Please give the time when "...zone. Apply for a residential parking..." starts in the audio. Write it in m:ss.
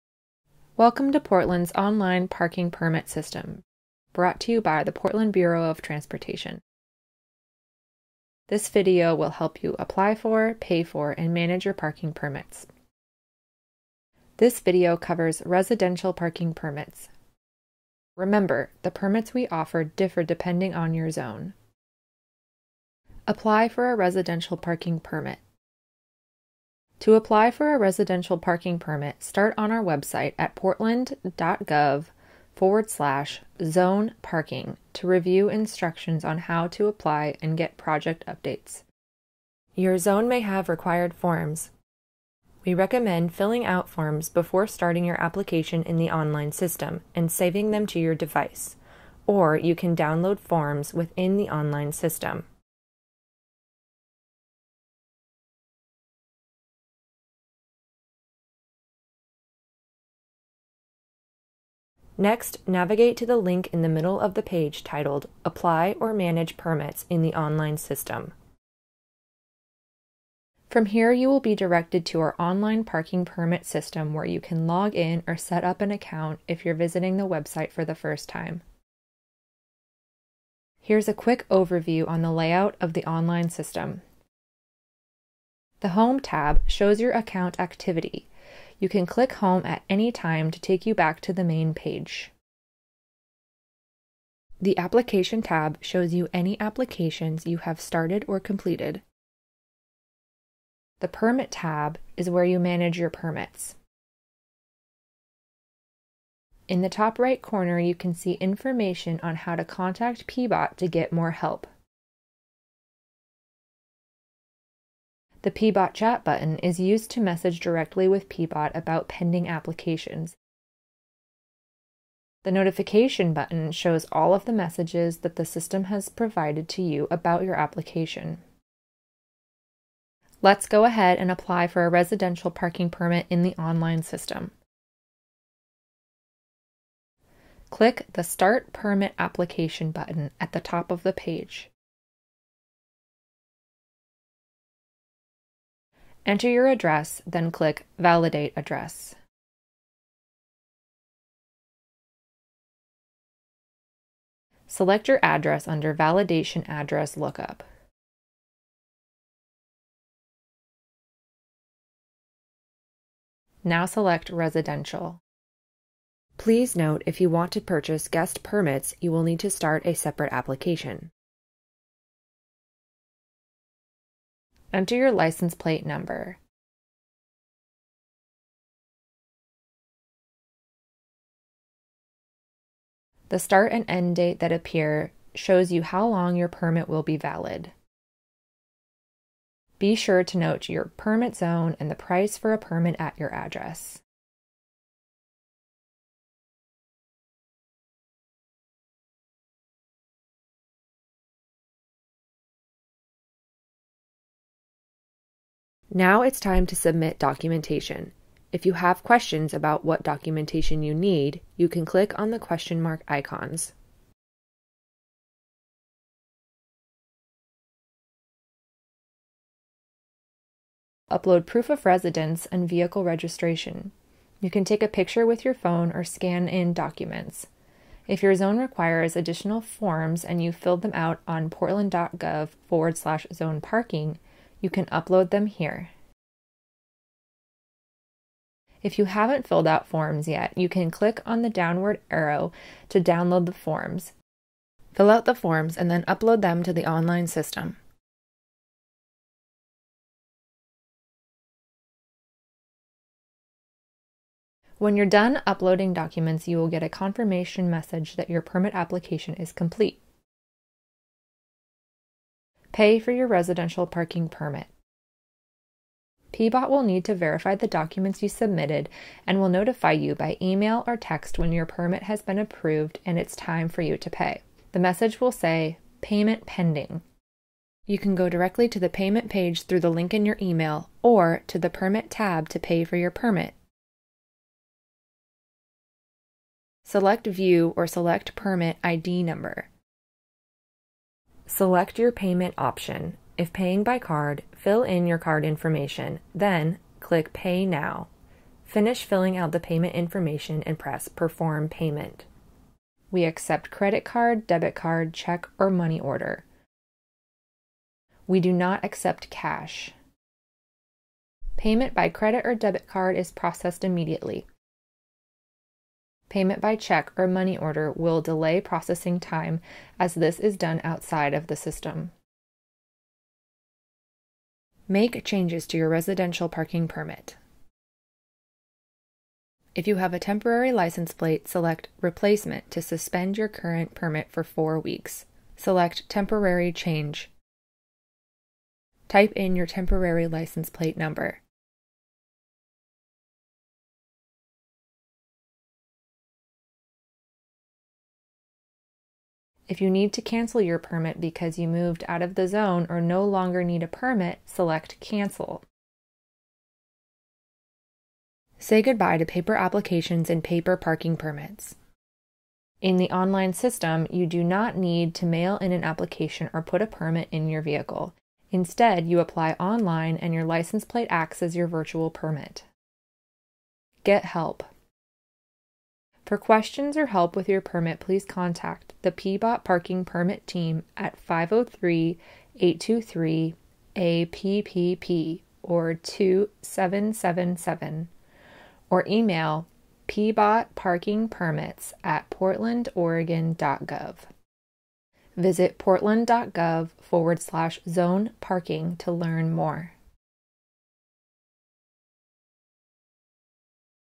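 0:21.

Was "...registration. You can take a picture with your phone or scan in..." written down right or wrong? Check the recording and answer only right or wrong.
right.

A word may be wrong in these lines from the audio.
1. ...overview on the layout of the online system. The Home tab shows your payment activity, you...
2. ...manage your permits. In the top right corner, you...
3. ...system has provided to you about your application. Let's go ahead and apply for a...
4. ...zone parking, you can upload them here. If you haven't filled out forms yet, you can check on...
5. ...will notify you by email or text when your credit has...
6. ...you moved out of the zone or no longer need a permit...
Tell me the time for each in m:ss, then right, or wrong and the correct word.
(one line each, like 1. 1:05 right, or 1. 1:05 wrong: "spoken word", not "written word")
1. 1:21 wrong: "account", not "payment"
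2. 1:42 right
3. 2:05 right
4. 3:53 wrong: "click", not "check"
5. 4:29 wrong: "permit", not "credit"
6. 5:51 right.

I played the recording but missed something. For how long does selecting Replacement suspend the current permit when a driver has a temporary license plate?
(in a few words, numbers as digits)
4 weeks.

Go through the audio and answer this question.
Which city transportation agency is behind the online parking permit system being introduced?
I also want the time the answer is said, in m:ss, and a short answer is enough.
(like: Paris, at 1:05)
Portland Bureau of Transportation, at 0:04.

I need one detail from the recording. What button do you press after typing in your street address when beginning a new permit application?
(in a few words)
Validate Address.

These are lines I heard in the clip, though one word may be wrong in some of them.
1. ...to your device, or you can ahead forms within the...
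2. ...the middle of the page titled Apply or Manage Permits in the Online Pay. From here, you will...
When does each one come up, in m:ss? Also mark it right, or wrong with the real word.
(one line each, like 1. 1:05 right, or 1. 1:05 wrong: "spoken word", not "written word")
1. 0:47 wrong: "download", not "ahead"
2. 1:03 wrong: "System", not "Pay".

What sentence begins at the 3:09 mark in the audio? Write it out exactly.
Be sure to note your permit zone and the price for a permit at your address.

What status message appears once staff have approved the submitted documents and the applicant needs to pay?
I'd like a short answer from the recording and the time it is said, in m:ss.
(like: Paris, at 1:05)
Payment Pending, at 4:36.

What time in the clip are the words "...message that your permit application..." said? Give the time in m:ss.
4:17.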